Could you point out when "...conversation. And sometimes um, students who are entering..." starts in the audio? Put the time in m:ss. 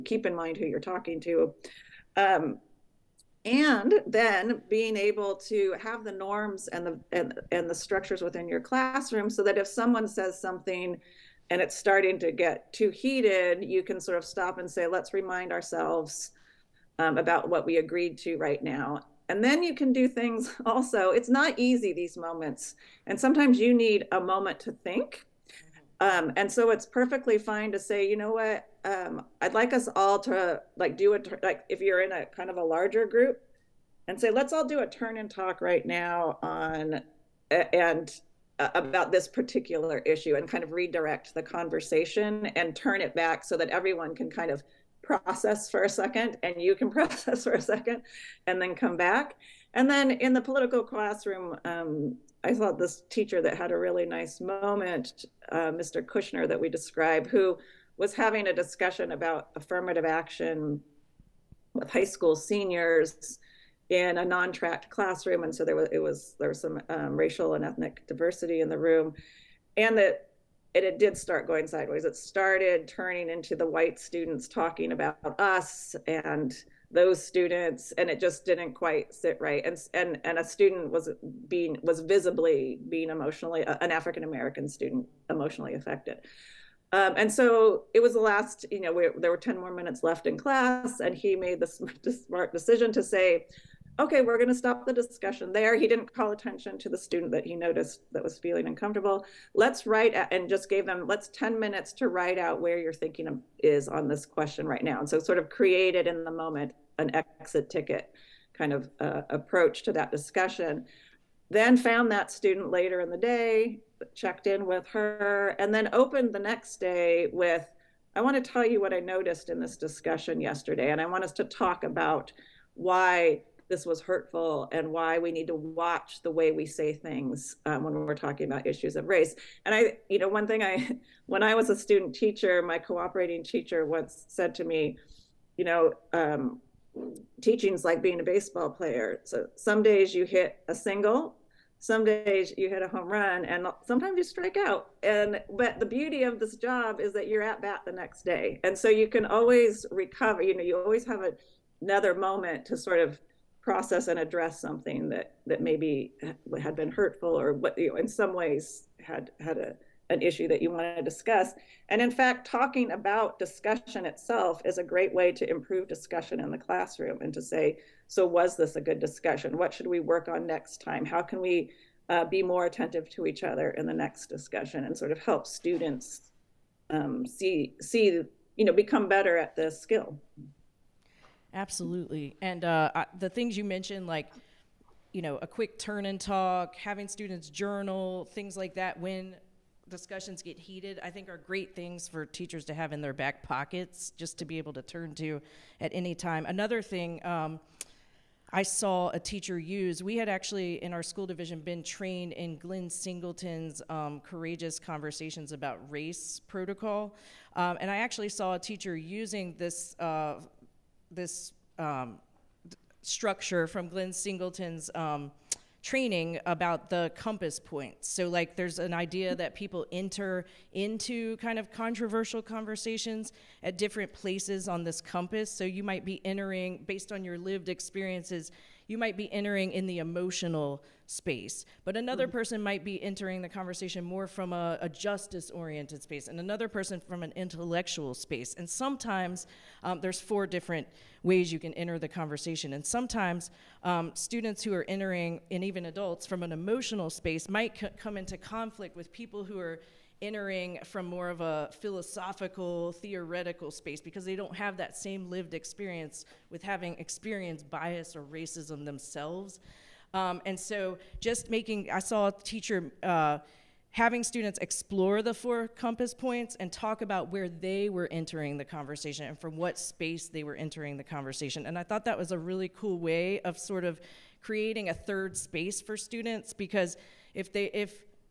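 4:02.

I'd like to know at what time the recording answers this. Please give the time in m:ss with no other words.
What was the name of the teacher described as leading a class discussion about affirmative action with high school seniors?
0:55.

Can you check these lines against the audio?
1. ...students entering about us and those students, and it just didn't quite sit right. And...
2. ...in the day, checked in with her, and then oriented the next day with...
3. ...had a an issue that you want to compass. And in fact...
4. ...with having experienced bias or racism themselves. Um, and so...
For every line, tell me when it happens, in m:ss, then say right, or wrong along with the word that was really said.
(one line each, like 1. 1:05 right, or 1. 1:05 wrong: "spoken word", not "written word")
1. 1:13 wrong: "talking", not "entering"
2. 1:53 wrong: "opened", not "oriented"
3. 2:39 wrong: "discuss", not "compass"
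4. 4:16 right.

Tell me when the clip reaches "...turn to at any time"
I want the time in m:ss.
3:14.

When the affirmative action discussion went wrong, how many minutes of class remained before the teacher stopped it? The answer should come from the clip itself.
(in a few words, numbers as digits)
10.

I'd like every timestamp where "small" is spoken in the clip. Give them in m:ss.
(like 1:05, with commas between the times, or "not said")
not said.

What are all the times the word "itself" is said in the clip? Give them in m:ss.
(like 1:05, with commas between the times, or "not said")
2:44.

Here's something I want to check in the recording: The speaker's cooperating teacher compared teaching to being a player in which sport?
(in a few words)
Baseball.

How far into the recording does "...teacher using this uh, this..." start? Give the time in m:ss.
3:28.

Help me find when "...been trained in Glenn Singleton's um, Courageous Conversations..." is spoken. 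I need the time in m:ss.
3:21.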